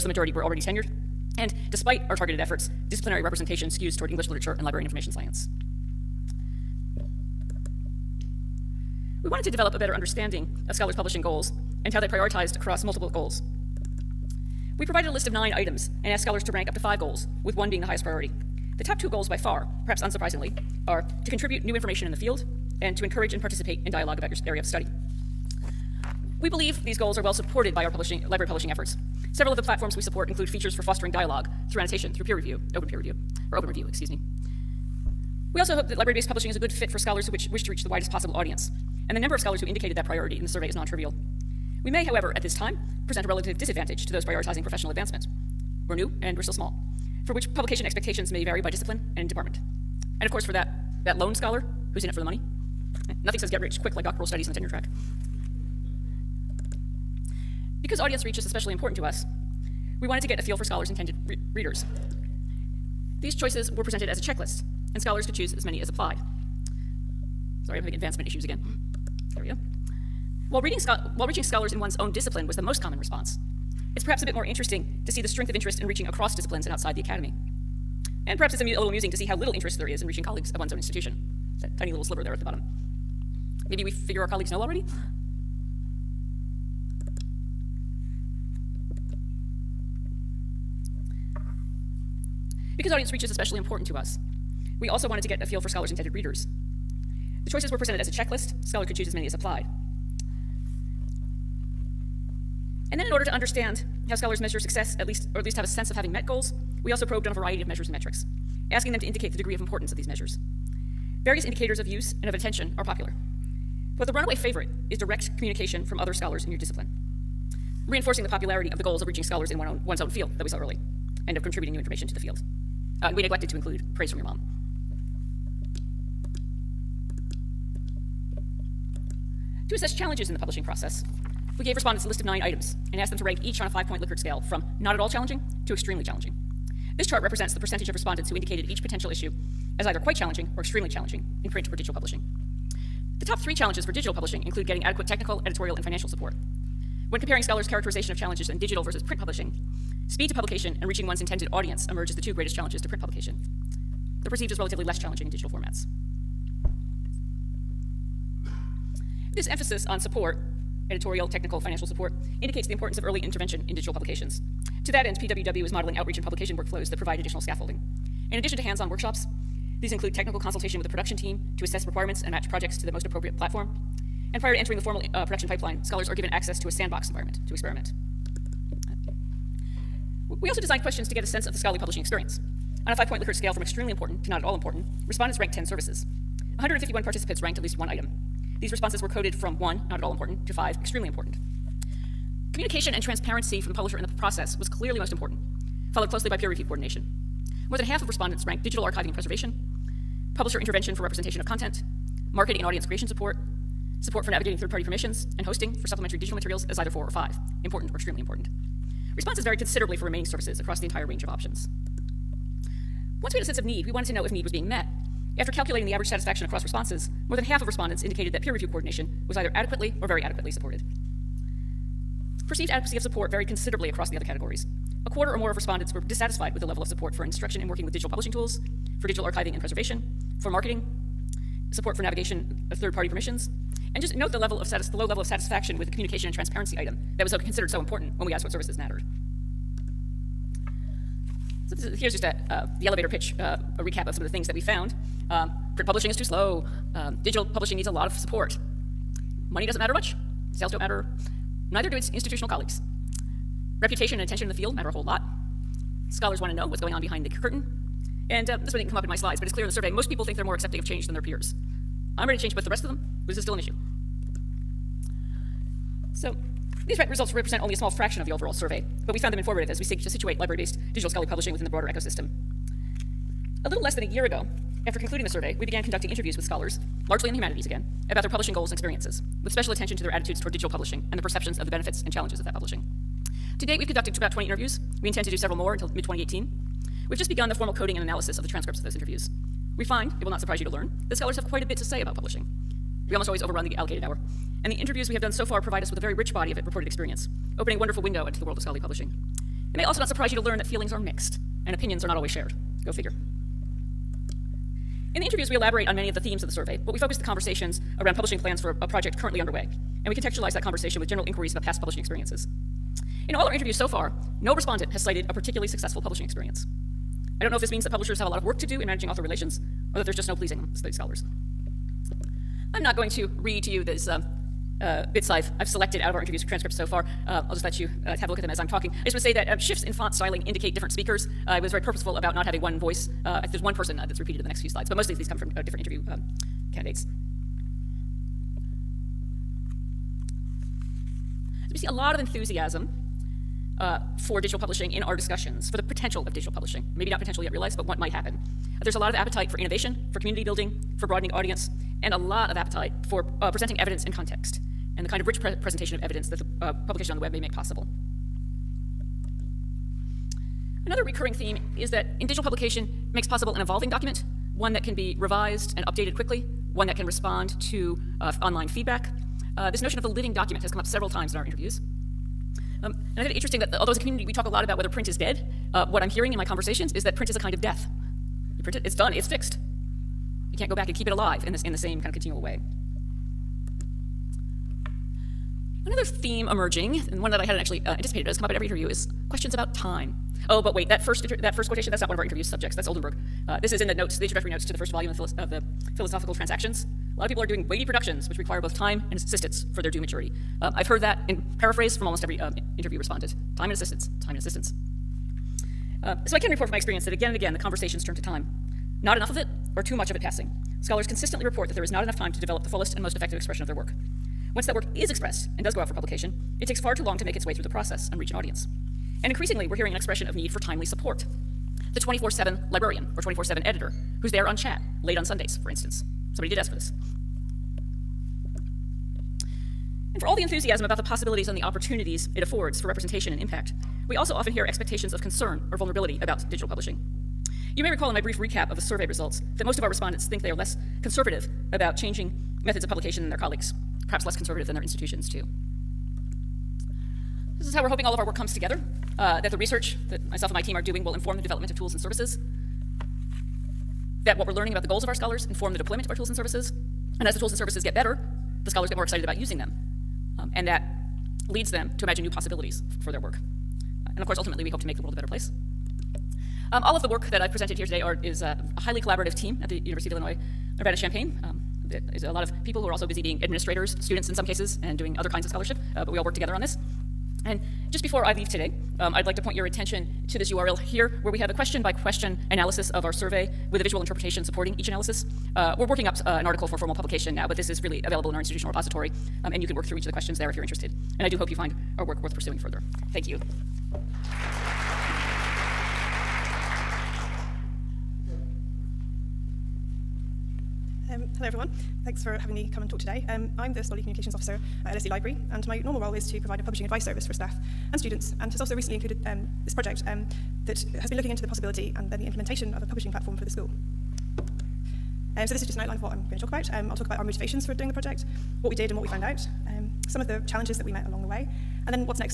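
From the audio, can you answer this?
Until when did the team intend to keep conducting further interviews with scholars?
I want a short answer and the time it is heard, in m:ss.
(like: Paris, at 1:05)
Mid 2018, at 4:45.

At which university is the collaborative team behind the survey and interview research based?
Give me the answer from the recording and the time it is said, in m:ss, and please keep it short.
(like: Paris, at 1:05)
University of Illinois Urbana-Champaign, at 7:49.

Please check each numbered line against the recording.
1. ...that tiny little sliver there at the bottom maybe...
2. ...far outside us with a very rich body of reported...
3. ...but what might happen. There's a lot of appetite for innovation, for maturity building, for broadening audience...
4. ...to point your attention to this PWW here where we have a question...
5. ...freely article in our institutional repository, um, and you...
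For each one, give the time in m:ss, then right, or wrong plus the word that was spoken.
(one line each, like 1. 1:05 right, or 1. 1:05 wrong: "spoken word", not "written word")
1. 1:21 right
2. 4:55 wrong: "provide", not "outside"
3. 5:47 wrong: "community", not "maturity"
4. 7:59 wrong: "URL", not "PWW"
5. 8:07 wrong: "available", not "article".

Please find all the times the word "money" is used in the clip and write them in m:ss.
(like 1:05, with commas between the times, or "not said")
0:52, 4:09.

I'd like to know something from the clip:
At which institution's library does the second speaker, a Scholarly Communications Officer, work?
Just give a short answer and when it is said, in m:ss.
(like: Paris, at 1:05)
LSE, at 8:24.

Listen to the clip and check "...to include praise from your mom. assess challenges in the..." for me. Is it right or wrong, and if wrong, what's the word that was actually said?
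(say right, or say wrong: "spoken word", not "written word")
right.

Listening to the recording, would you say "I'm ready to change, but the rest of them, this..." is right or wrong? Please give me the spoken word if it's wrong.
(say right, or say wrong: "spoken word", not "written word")
right.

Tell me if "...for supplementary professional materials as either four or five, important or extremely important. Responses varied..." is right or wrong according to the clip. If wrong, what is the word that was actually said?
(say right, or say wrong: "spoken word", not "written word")
wrong: "digital", not "professional".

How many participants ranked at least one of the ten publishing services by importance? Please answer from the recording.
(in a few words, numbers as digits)
151.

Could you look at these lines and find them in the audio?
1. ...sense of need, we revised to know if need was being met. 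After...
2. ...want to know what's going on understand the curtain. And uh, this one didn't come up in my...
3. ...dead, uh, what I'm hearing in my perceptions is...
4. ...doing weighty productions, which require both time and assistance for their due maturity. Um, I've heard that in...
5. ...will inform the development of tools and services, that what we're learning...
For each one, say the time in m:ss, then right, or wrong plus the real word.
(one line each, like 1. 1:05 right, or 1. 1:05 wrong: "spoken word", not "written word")
1. 3:33 wrong: "wanted", not "revised"
2. 4:16 wrong: "behind", not "understand"
3. 6:15 wrong: "conversations", not "perceptions"
4. 6:37 right
5. 7:31 right.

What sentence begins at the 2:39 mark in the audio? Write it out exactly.
This emphasis on support, editorial, technical, financial support, indicates the importance of early intervention in digital publications.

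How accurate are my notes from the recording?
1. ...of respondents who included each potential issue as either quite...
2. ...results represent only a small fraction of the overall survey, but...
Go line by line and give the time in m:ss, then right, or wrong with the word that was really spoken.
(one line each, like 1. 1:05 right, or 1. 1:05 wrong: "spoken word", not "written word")
1. 2:17 wrong: "indicated", not "included"
2. 4:27 right.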